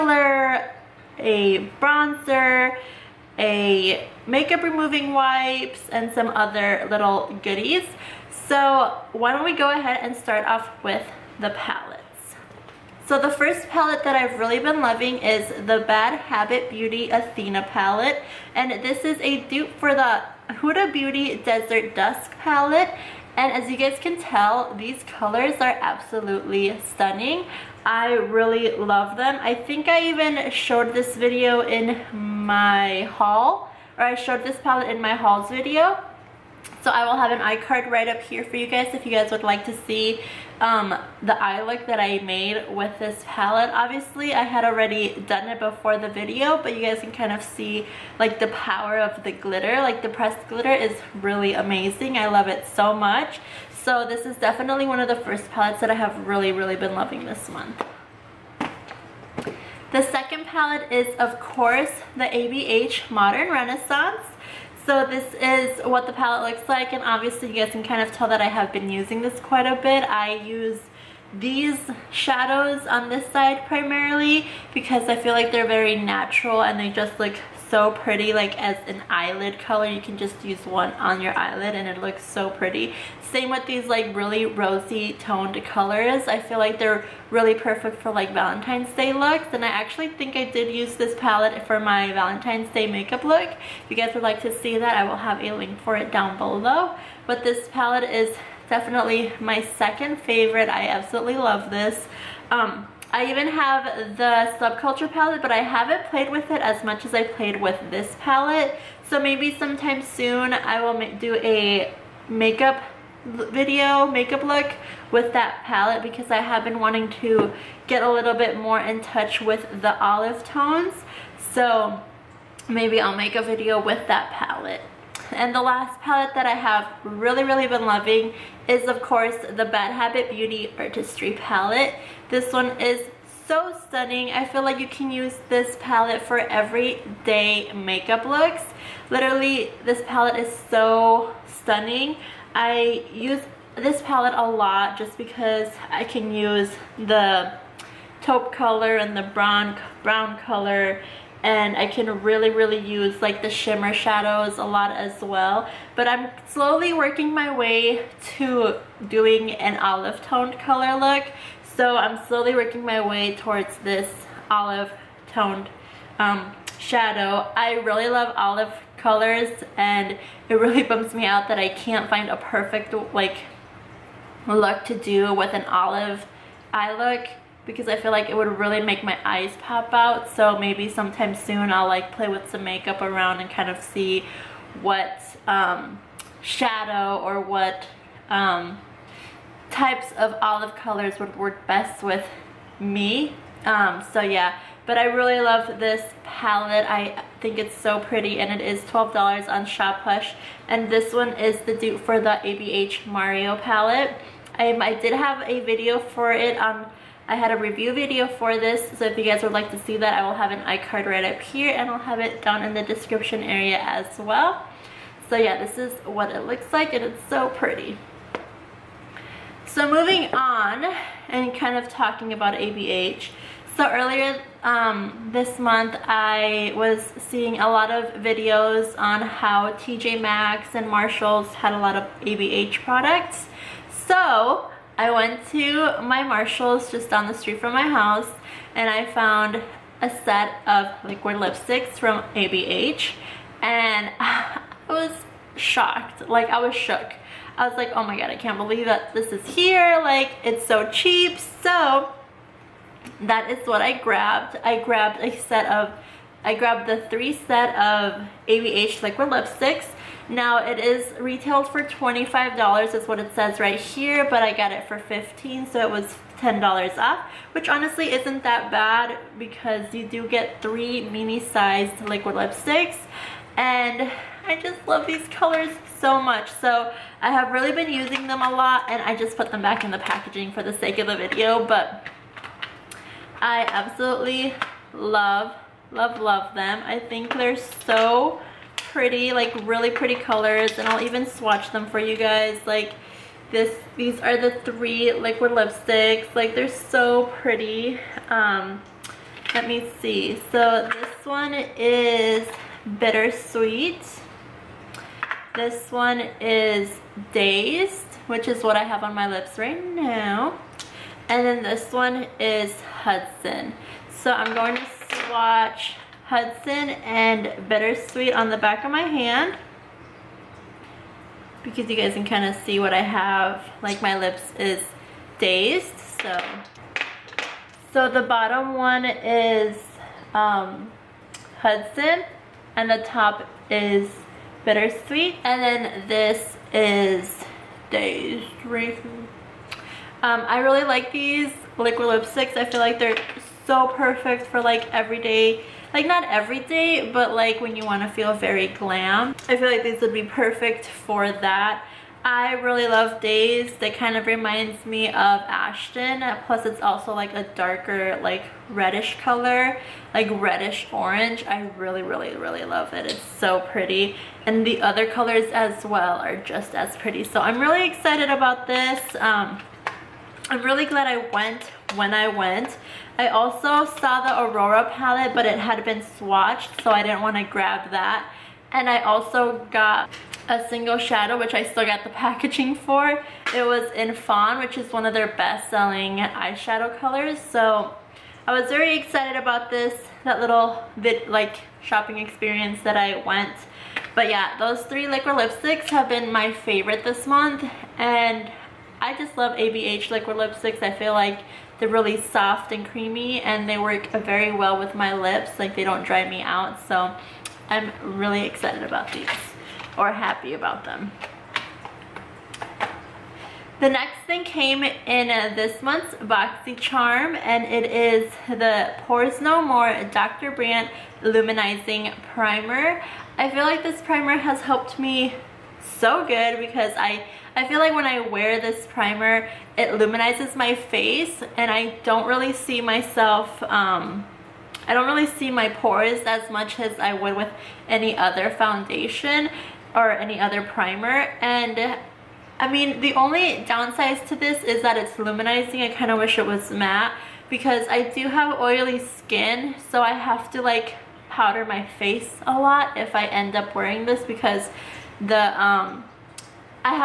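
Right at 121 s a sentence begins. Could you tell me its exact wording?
So maybe I'll make a video with that palette.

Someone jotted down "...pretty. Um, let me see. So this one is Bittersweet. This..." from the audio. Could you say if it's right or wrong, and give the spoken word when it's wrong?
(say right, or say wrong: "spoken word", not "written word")
right.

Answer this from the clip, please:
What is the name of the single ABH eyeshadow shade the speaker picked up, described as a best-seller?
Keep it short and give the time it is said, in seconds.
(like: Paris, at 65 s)
Fawn, at 384 s.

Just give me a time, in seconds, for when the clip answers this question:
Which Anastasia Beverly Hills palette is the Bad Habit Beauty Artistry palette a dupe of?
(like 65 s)
202 s.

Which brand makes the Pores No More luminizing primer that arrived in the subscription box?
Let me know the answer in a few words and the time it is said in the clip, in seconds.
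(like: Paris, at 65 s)
Dr. Brandt, at 420 s.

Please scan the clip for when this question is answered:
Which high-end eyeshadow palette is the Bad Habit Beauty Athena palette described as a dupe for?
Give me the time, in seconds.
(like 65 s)
20 s.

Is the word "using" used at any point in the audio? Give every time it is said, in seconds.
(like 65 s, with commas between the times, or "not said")
68 s, 277 s.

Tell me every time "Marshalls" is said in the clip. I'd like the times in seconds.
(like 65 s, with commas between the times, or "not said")
230 s, 236 s.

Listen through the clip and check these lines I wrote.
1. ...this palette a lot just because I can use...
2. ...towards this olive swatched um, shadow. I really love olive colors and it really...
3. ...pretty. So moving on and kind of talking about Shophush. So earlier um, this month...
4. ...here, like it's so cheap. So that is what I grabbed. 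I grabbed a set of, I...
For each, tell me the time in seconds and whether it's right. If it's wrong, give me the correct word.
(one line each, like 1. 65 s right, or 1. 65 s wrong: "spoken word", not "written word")
1. 143 s right
2. 163 s wrong: "toned", not "swatched"
3. 217 s wrong: "ABH", not "Shophush"
4. 249 s right.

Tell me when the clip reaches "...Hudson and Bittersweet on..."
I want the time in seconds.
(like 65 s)
316 s.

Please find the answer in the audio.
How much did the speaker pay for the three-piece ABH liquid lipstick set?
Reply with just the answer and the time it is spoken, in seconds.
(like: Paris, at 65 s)
15, at 264 s.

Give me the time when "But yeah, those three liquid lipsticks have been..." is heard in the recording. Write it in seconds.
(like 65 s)
394 s.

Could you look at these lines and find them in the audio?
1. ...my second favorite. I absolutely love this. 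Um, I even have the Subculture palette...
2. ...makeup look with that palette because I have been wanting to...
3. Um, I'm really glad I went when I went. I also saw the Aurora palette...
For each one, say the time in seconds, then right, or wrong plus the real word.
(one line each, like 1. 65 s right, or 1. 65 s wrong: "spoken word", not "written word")
1. 99 s right
2. 114 s right
3. 369 s right.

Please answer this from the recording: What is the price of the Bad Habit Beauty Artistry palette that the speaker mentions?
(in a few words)
$12.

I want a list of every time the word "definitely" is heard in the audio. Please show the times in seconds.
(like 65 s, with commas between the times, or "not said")
54 s, 98 s.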